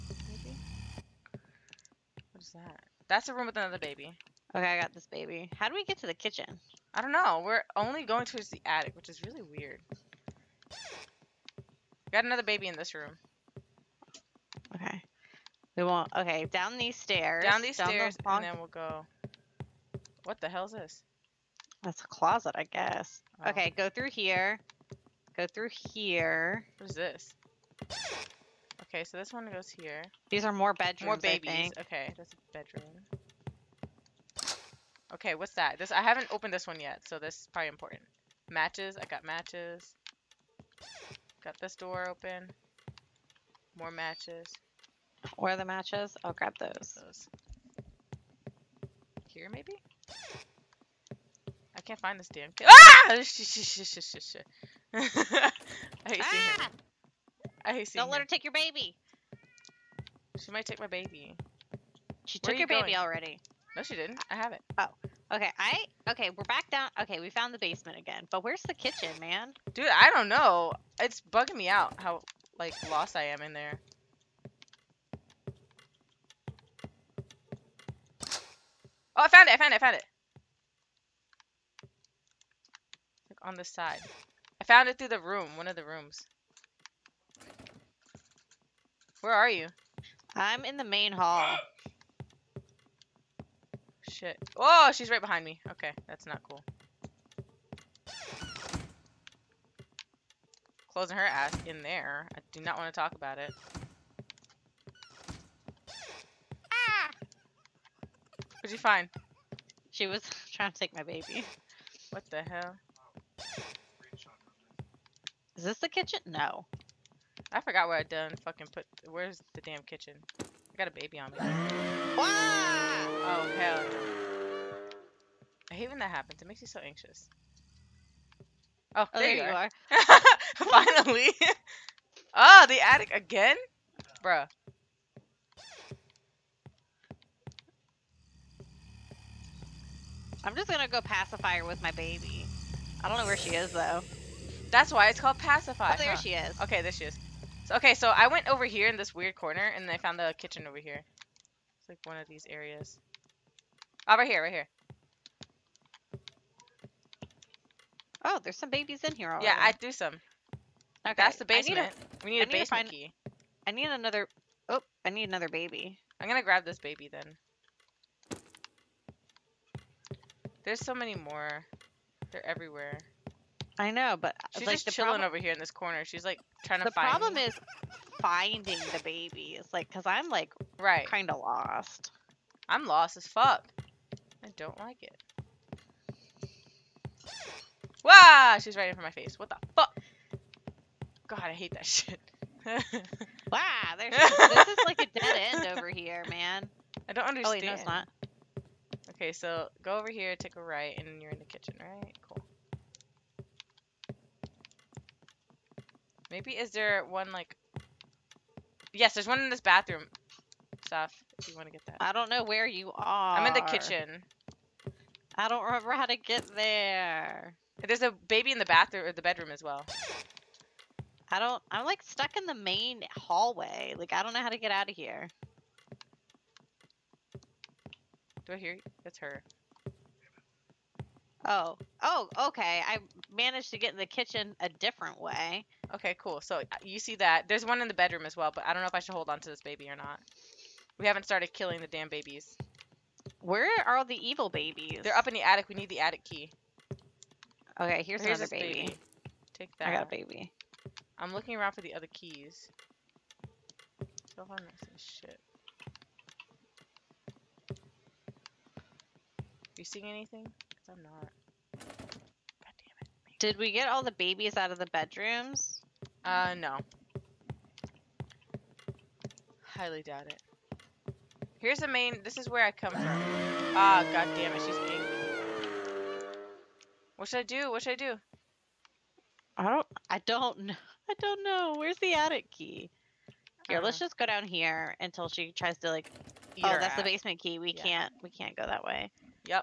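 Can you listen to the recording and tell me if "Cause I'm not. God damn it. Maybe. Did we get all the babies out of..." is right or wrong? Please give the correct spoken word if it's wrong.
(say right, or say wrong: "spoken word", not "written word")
right.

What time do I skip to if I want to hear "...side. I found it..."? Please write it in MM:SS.
01:23.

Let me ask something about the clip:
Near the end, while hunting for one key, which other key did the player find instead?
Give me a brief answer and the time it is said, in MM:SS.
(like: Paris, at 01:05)
Basement key, at 04:46.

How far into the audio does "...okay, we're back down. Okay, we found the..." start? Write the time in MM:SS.
01:06.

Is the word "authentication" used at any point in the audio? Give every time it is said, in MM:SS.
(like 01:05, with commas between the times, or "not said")
not said.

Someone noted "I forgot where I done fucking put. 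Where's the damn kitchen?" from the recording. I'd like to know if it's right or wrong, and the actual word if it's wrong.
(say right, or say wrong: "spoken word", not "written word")
right.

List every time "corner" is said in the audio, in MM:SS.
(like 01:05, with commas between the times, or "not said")
02:29, 02:55.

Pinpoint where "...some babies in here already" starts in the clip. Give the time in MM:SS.
02:38.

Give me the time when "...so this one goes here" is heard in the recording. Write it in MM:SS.
00:29.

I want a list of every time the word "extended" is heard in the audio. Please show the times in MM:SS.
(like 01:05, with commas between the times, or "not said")
not said.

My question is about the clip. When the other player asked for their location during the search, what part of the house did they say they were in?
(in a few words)
Main hall.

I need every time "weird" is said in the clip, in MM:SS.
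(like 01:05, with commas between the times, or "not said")
00:09, 02:29.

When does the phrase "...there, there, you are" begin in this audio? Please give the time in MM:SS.
02:09.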